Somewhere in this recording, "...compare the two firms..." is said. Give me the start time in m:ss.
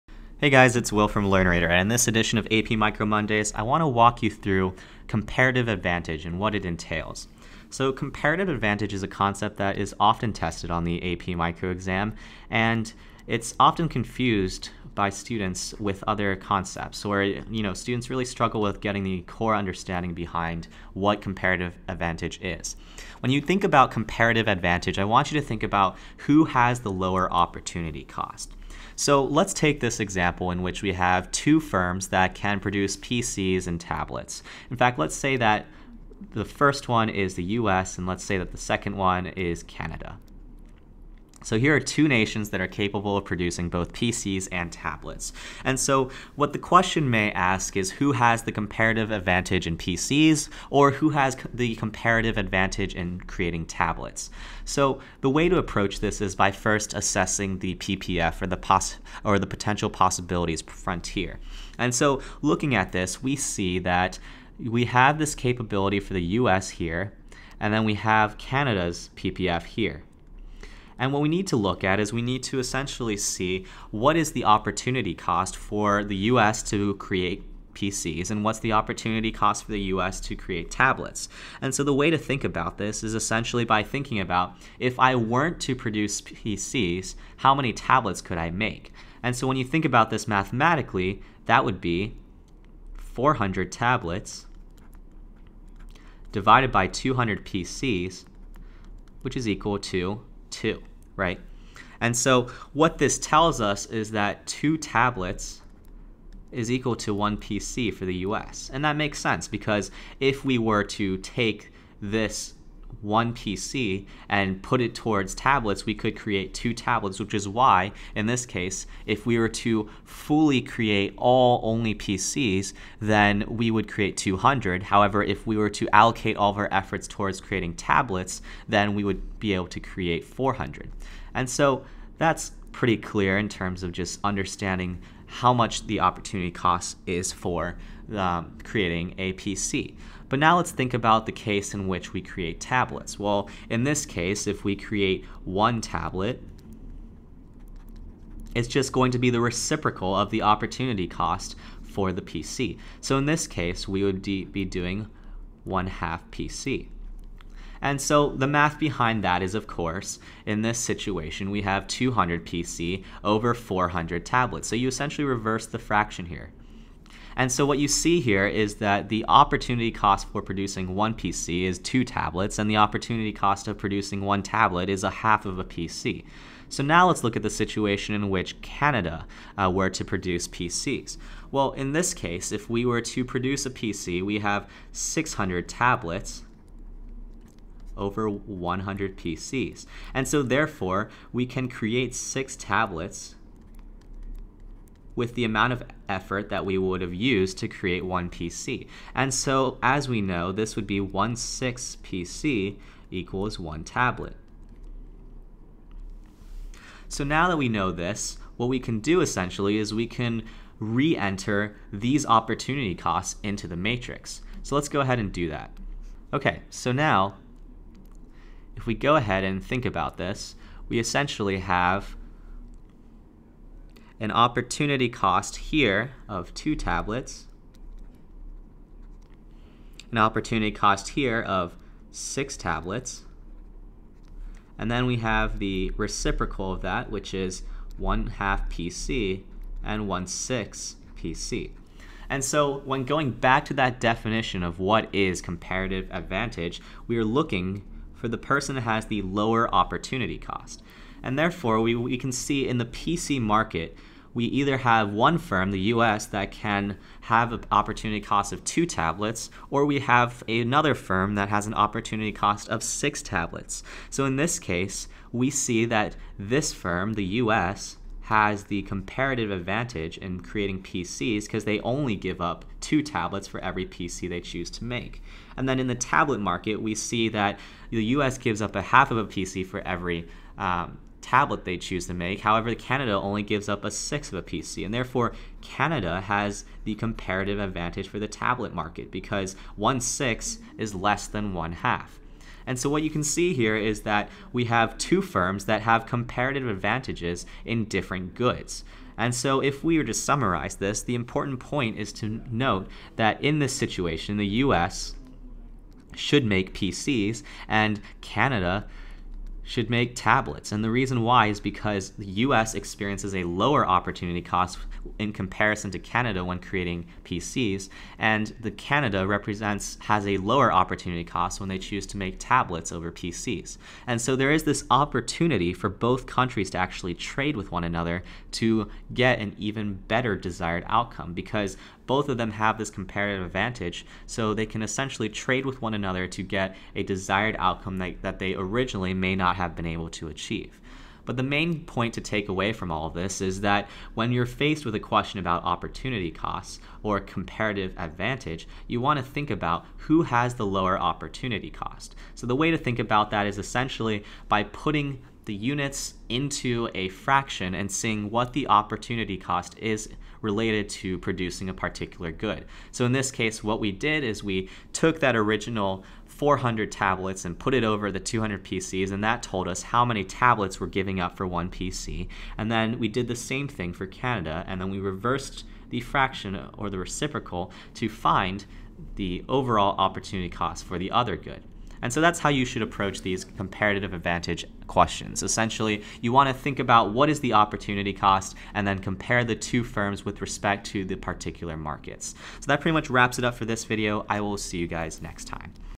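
6:28.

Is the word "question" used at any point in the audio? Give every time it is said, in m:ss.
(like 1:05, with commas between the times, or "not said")
0:46, 5:44, 6:24.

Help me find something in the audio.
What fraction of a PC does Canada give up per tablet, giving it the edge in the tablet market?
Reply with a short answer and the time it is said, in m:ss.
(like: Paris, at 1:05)
1/6, at 4:43.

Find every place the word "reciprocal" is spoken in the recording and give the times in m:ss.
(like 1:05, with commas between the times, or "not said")
2:29, 3:55, 6:16.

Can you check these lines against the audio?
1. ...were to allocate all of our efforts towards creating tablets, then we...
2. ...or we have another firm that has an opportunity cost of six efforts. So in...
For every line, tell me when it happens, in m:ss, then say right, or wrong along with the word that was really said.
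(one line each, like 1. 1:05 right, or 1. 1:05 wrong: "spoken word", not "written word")
1. 2:05 right
2. 4:19 wrong: "tablets", not "efforts".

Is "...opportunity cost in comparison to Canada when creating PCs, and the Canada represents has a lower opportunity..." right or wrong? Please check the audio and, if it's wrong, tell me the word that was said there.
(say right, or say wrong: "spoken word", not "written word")
right.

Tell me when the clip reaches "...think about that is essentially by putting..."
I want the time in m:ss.
5:52.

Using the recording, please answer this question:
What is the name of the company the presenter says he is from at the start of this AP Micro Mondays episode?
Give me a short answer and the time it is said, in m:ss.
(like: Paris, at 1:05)
Learnerator, at 0:01.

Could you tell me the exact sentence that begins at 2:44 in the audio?
So you essentially reverse the fraction here.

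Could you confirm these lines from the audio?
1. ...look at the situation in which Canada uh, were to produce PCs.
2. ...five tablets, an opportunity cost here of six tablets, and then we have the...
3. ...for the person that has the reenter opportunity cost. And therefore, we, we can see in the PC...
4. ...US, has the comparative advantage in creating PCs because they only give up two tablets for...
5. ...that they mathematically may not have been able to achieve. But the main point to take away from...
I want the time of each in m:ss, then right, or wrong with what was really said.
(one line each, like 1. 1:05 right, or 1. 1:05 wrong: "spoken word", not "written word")
1. 2:57 right
2. 3:46 wrong: "two", not "five"
3. 4:08 wrong: "lower", not "reenter"
4. 4:27 right
5. 5:38 wrong: "originally", not "mathematically".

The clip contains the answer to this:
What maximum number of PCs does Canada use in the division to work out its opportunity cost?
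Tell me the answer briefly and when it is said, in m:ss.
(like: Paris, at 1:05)
100, at 3:08.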